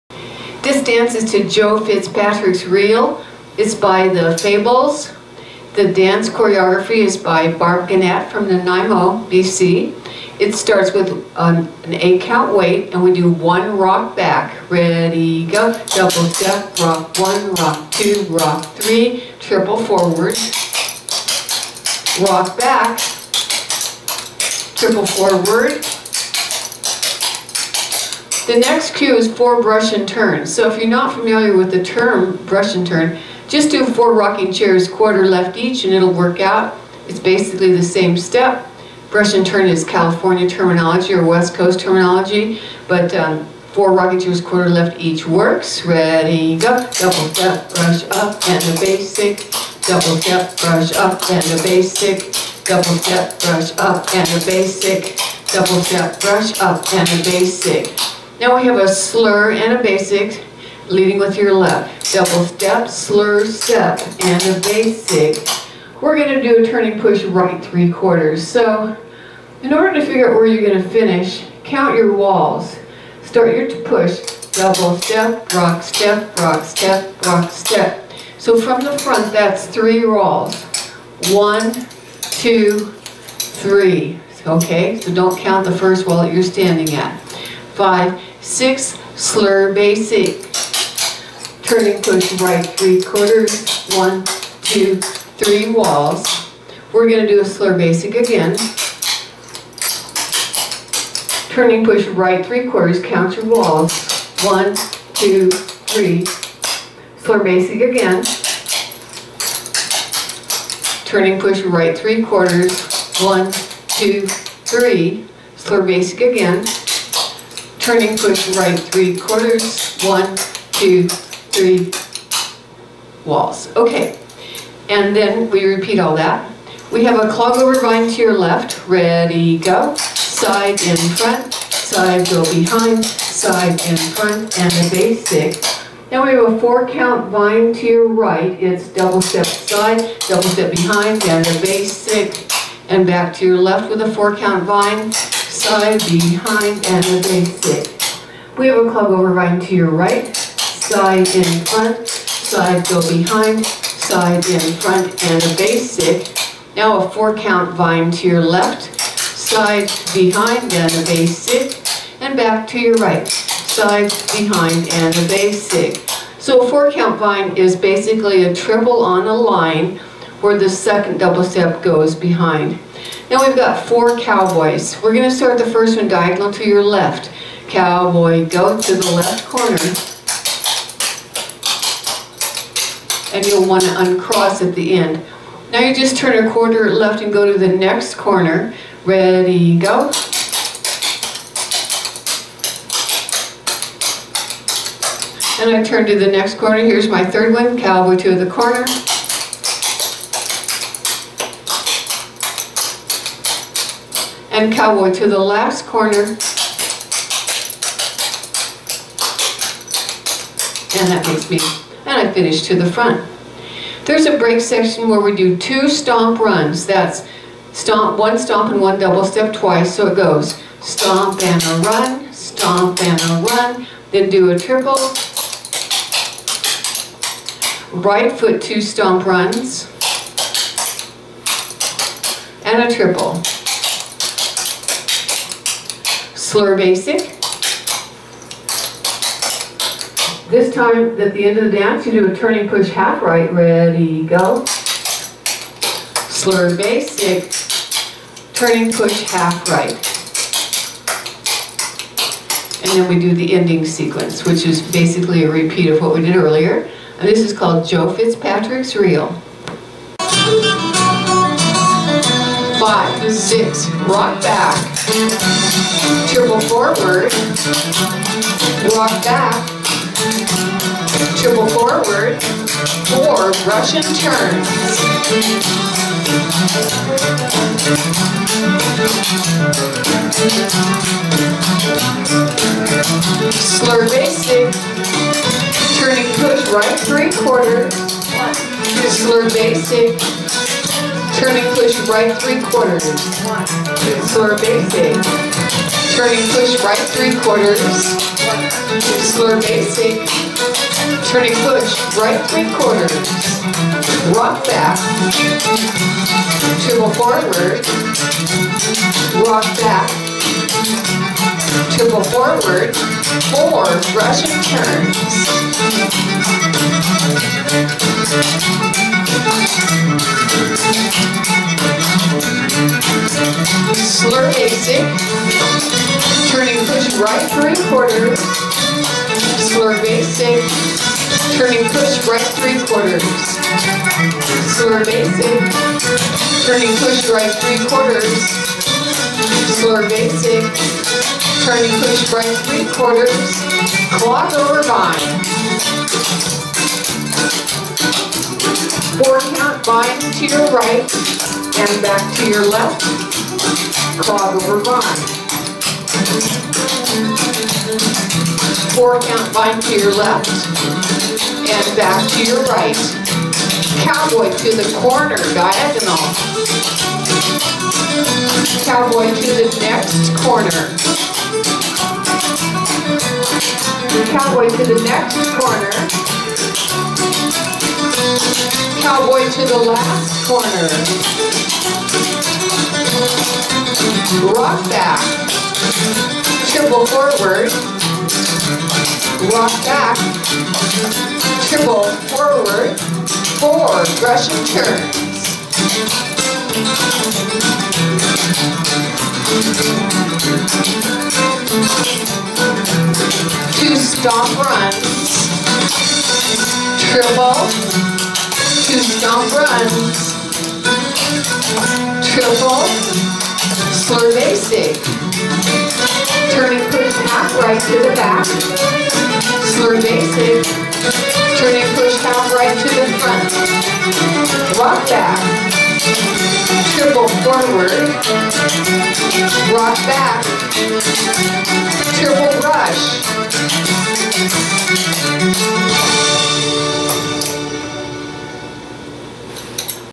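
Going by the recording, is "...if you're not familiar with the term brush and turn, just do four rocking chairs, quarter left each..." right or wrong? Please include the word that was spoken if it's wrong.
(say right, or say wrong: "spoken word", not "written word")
right.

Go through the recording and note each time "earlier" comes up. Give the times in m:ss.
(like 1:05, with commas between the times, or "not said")
4:16.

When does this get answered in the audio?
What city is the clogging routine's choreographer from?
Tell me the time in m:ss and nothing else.
0:08.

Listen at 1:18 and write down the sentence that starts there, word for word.
So from the front, that's three walls.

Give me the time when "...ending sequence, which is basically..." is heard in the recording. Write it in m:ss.
4:13.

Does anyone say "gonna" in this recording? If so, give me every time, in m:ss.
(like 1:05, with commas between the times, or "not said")
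1:06, 1:10, 1:37.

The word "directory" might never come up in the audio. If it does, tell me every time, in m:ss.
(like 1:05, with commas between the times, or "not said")
not said.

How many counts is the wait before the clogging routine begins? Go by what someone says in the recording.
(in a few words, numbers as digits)
8.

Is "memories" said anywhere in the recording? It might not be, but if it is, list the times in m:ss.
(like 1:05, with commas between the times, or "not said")
not said.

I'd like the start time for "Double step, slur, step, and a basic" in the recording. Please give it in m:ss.
1:02.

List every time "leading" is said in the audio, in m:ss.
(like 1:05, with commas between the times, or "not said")
1:00.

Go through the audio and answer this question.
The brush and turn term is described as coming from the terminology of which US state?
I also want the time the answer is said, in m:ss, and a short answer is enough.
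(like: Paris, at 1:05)
California, at 0:39.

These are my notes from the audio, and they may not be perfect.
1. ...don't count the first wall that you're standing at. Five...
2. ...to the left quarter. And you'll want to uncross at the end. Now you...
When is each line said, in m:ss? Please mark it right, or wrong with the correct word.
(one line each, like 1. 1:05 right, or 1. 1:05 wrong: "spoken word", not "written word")
1. 1:25 right
2. 2:58 wrong: "corner", not "quarter".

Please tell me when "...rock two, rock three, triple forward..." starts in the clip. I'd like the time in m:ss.
0:17.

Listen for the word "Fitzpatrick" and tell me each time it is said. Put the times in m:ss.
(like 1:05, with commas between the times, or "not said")
0:01, 4:18.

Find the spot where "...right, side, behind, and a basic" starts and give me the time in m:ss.
2:42.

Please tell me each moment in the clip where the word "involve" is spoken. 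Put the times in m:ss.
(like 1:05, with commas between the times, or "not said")
not said.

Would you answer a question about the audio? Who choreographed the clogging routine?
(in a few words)
Barb Guenette.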